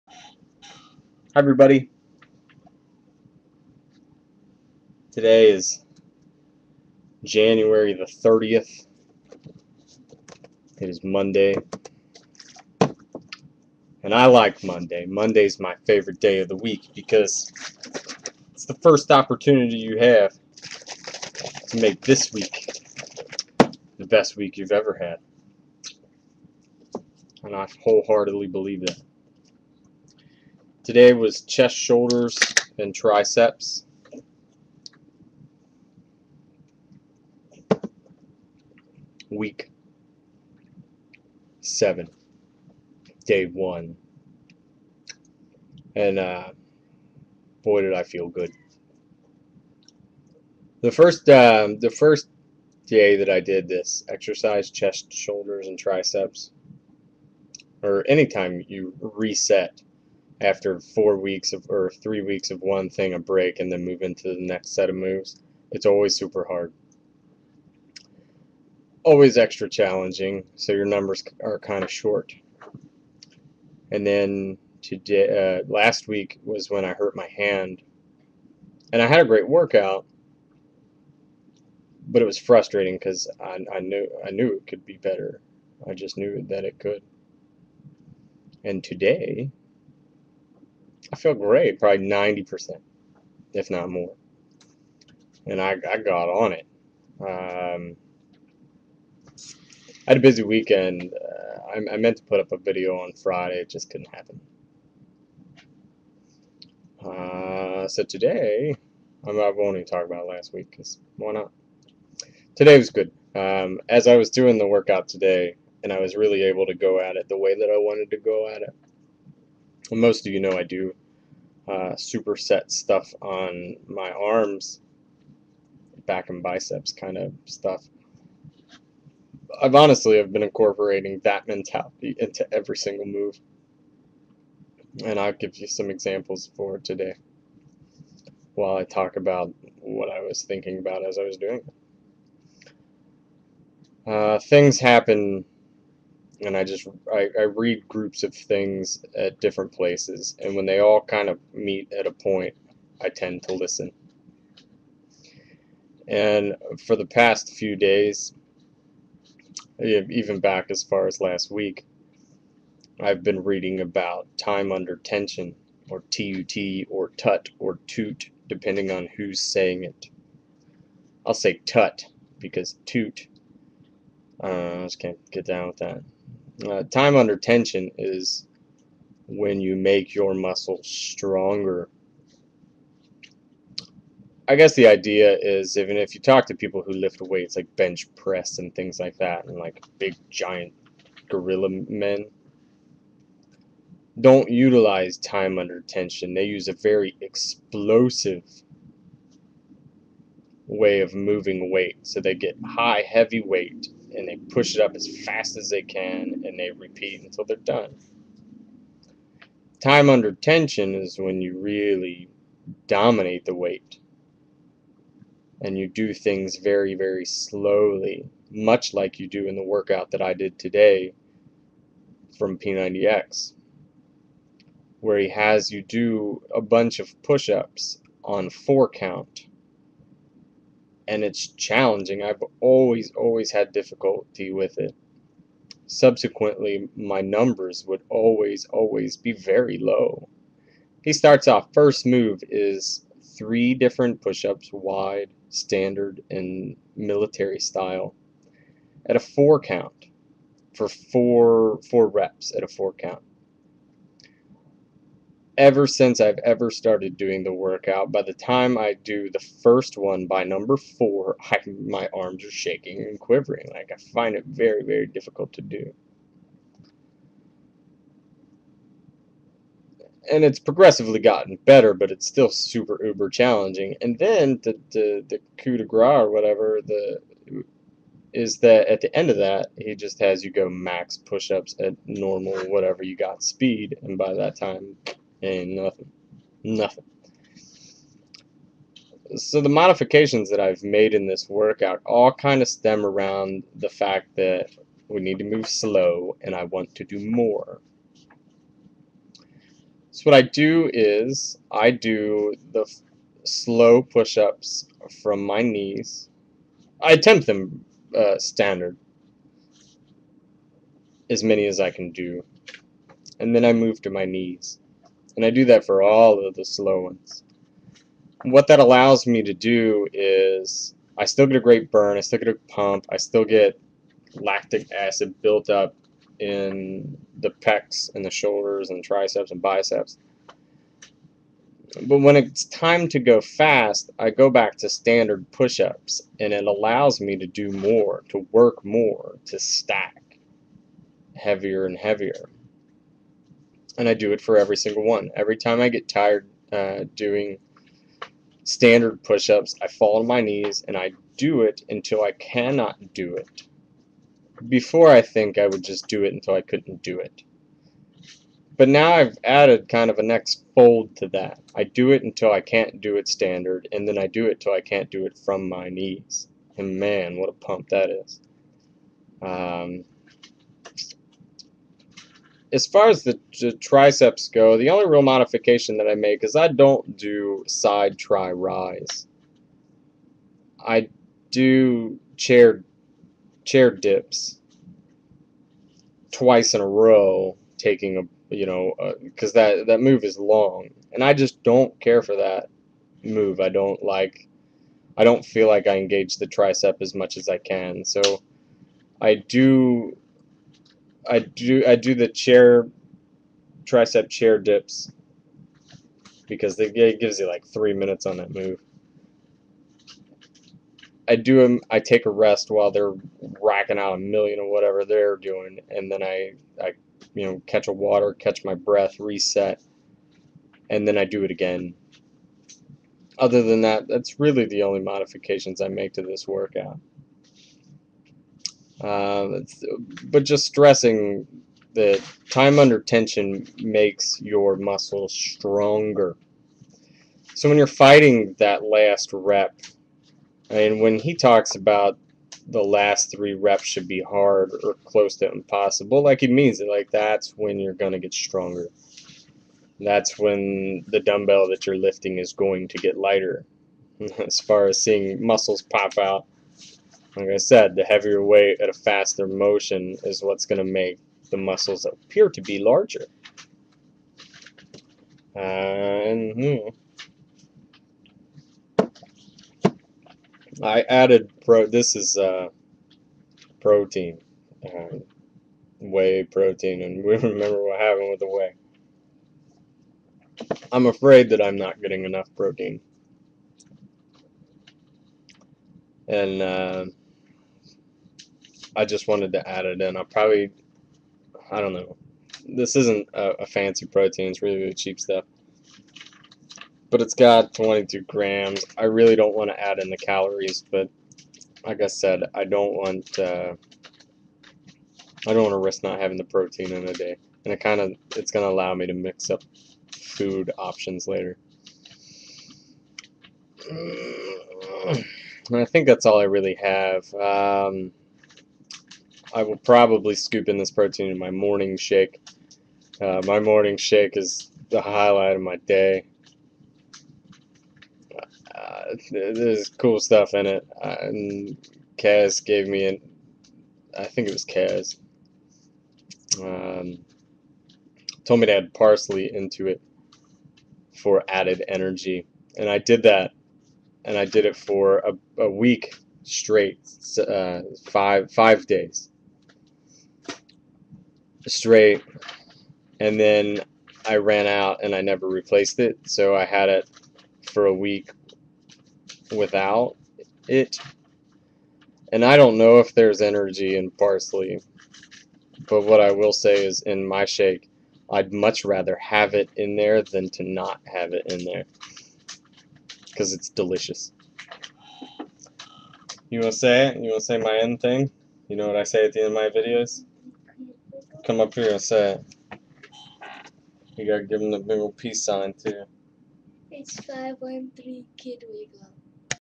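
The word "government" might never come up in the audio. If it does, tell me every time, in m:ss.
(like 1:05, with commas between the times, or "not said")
not said.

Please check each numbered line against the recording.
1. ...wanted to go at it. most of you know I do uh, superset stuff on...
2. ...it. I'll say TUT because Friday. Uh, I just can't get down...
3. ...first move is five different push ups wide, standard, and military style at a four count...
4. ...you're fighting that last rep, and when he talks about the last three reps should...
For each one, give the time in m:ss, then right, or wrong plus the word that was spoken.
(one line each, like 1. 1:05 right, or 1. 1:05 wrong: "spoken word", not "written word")
1. 1:57 right
2. 2:49 wrong: "TOOT", not "Friday"
3. 4:01 wrong: "three", not "five"
4. 7:17 right.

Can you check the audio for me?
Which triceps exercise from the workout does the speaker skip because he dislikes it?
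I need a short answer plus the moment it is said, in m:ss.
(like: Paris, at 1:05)
side Tri-Rise, at 6:17.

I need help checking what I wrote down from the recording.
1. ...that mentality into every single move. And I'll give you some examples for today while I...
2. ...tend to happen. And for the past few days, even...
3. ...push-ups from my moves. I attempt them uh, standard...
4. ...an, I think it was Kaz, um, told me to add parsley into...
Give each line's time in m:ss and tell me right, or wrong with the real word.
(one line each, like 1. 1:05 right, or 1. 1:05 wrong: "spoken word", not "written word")
1. 2:11 right
2. 2:33 wrong: "listen", not "happen"
3. 5:04 wrong: "knees", not "moves"
4. 8:53 right.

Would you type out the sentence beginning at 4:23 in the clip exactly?
Like I find it very, very difficult to do.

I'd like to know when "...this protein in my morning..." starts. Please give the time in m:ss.
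8:40.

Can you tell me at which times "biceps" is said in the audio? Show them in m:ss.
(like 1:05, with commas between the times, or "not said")
2:06, 5:29.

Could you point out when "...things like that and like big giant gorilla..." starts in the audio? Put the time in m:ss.
3:08.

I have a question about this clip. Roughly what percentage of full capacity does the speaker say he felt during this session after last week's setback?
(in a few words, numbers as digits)
90%.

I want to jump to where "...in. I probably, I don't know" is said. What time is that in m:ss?
8:10.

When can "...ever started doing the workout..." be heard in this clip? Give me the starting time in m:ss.
4:16.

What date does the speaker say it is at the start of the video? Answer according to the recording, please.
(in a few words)
January 30th.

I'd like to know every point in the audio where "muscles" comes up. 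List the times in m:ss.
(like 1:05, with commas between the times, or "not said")
3:00, 7:14, 7:35, 7:41.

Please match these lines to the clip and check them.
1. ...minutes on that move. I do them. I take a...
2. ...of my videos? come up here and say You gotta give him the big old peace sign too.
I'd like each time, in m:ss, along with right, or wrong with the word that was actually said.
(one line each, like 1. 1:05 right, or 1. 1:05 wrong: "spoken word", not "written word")
1. 6:47 right
2. 9:39 right.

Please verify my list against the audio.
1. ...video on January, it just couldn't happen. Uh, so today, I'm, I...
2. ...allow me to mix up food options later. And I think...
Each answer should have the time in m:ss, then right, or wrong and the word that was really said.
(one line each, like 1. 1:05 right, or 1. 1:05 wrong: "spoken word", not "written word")
1. 1:42 wrong: "Friday", not "January"
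2. 8:28 right.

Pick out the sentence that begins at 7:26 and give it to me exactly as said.
Like that's when you're going to get stronger.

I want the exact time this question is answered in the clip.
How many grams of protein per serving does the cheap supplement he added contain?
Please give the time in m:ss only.
8:17.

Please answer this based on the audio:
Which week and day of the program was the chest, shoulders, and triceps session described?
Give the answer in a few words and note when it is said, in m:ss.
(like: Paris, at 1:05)
Week 7, day 1, at 0:39.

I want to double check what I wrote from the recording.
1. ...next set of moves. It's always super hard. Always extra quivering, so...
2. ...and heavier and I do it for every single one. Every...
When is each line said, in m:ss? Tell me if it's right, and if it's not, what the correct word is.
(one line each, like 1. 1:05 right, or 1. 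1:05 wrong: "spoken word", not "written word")
1. 1:04 wrong: "challenging", not "quivering"
2. 5:41 right.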